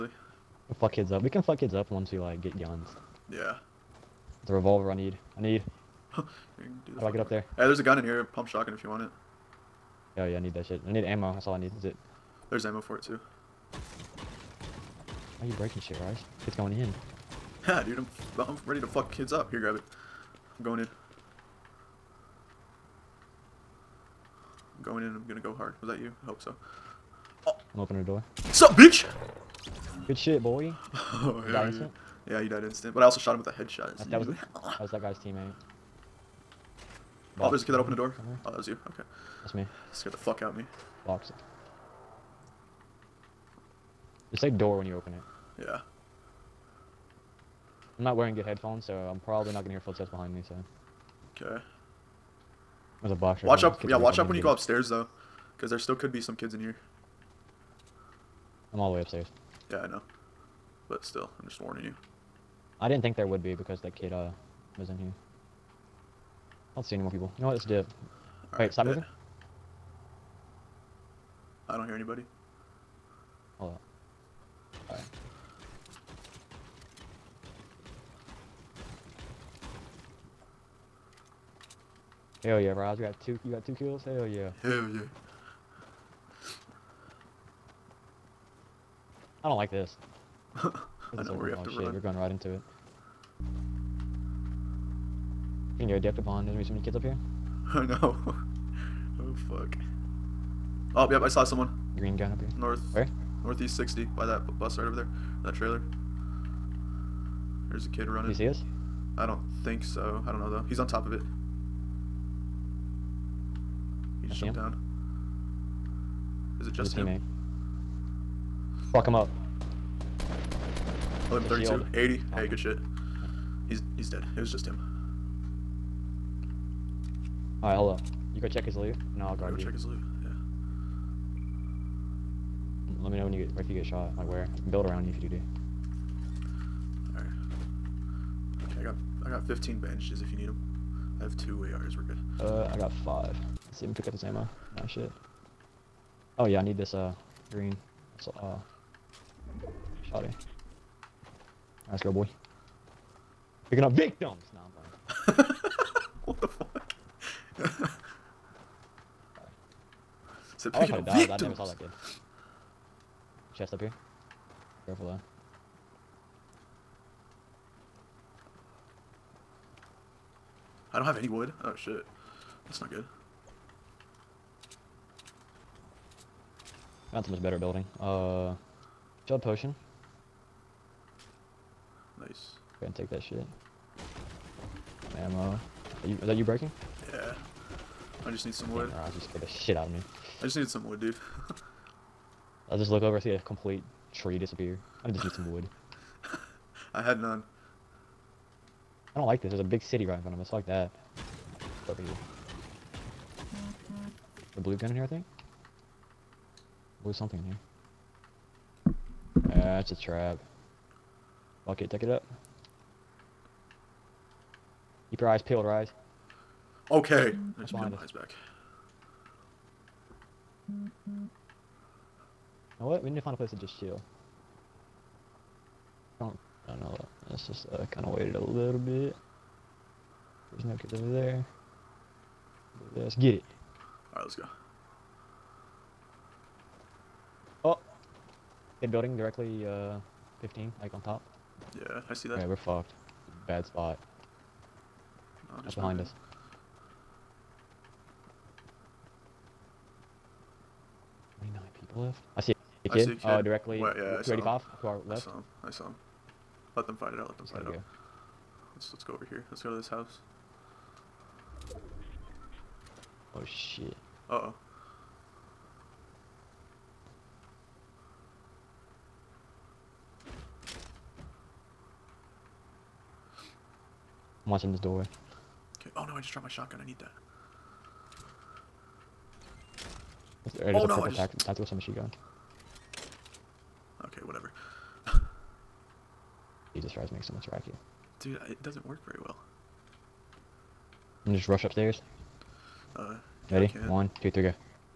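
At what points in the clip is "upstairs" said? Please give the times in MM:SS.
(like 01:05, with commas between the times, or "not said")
00:54, 00:59, 04:51.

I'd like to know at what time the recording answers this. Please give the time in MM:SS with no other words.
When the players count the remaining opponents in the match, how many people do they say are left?
04:11.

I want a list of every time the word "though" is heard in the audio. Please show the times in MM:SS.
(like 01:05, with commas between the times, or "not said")
00:54, 01:50, 02:45.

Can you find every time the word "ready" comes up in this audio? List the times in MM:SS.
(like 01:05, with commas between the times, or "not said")
00:18, 04:53.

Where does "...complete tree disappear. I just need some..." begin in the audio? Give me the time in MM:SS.
03:13.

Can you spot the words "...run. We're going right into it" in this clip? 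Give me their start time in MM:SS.
01:31.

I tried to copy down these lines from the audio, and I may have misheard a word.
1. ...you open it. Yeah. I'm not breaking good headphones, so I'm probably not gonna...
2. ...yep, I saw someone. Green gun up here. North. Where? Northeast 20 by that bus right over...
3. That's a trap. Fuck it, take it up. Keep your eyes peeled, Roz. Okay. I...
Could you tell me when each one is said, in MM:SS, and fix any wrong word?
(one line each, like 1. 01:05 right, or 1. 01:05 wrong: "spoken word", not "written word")
1. 00:44 wrong: "wearing", not "breaking"
2. 01:41 wrong: "60", not "20"
3. 03:29 wrong: "Rise", not "Roz".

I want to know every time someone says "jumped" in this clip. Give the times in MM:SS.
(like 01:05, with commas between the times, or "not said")
01:54.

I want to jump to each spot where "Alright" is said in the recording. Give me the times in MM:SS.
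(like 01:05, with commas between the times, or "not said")
02:07, 02:17, 03:54.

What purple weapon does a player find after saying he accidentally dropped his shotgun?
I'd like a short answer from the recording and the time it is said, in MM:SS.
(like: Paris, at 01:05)
Tactical submachine gun, at 04:41.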